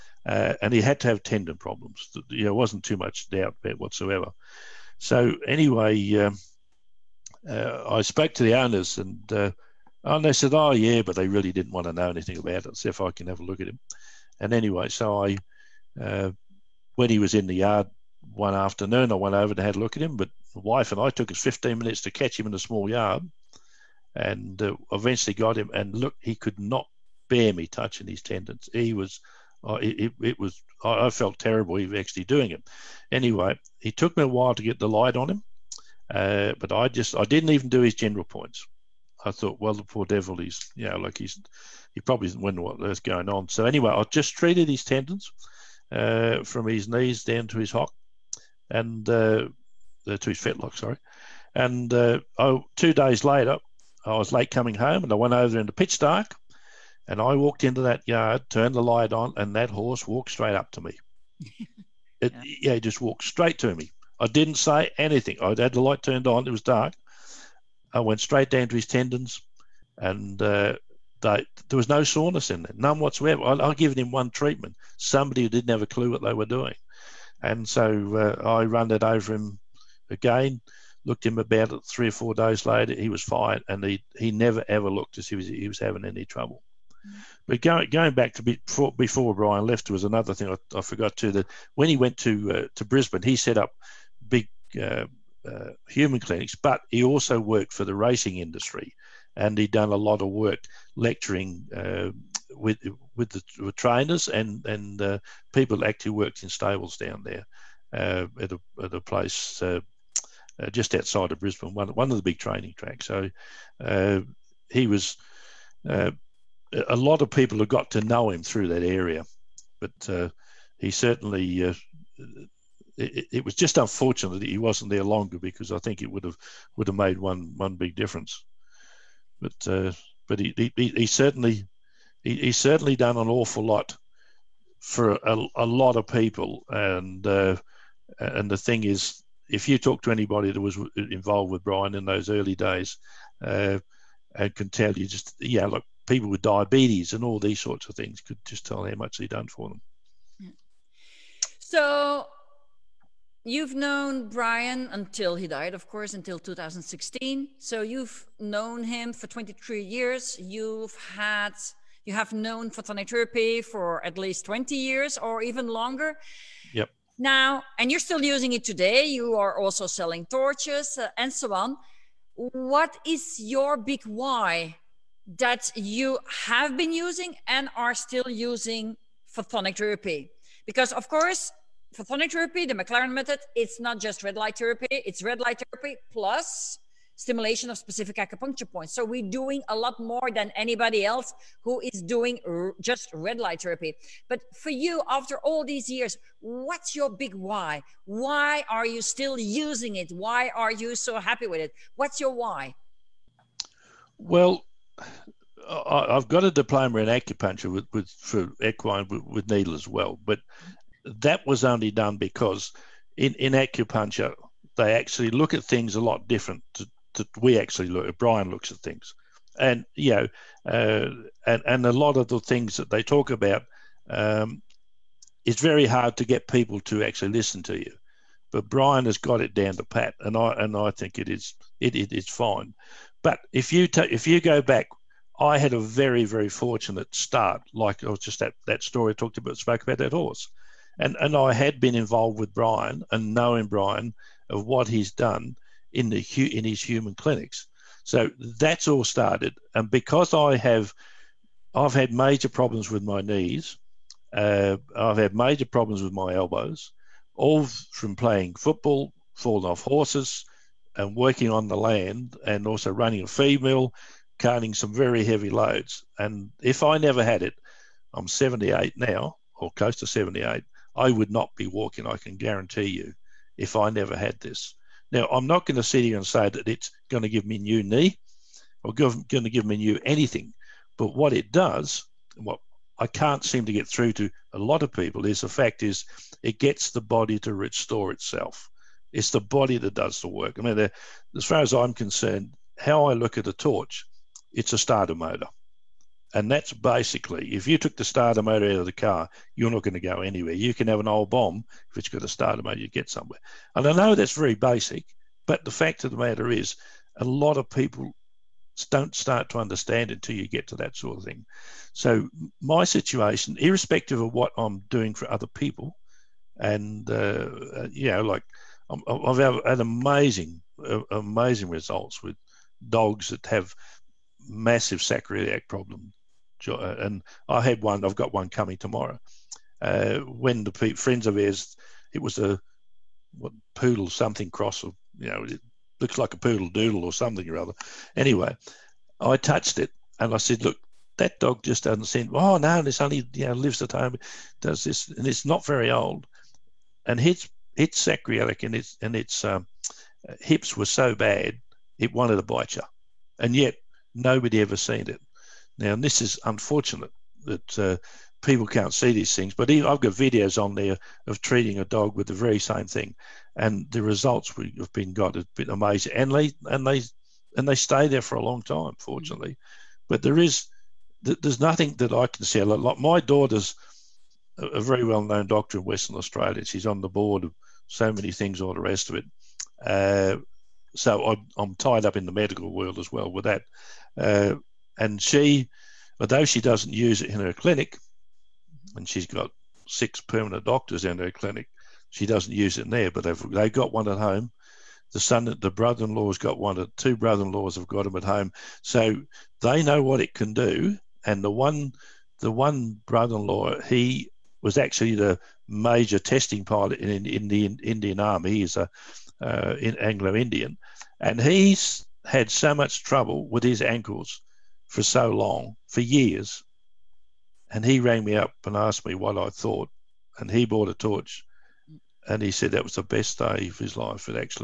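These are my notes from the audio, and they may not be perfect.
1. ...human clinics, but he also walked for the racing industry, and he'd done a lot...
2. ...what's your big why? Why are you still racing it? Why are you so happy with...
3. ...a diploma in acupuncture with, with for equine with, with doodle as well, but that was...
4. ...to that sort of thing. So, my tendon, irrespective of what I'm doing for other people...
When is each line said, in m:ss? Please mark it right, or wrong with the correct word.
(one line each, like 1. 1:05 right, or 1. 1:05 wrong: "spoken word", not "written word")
1. 1:35 wrong: "worked", not "walked"
2. 3:16 wrong: "using", not "racing"
3. 3:26 wrong: "needle", not "doodle"
4. 5:10 wrong: "situation", not "tendon".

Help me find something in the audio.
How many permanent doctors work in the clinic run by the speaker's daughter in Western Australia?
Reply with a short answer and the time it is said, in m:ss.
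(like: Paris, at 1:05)
6, at 6:29.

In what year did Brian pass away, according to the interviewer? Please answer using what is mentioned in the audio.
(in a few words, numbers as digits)
2016.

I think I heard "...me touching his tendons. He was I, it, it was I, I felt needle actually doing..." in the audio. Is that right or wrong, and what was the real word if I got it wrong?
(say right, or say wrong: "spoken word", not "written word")
wrong: "terrible", not "needle".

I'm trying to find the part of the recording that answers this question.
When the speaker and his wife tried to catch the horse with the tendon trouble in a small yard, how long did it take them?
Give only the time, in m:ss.
0:21.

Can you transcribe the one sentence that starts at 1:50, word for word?
just outside of Brisbane, one, one of the big training tracks.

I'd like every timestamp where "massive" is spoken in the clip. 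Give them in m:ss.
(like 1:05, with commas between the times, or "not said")
5:24.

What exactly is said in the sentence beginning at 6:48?
He's a uh, in Anglo-Indian, and he's had so much trouble with his ankles for so long, for years.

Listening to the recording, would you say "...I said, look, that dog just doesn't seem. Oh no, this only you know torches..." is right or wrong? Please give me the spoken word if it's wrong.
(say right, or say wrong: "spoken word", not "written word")
wrong: "lives", not "torches".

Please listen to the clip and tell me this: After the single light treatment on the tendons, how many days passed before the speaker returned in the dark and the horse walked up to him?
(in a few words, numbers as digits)
2 days.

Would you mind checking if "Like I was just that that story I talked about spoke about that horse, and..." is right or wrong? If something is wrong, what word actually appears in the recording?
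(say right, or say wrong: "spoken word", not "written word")
right.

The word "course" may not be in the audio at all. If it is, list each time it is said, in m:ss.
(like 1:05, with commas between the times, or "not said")
2:35, 3:01.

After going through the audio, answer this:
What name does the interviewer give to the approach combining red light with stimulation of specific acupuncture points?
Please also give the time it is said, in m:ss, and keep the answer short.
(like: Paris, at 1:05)
The McLaren method, at 3:02.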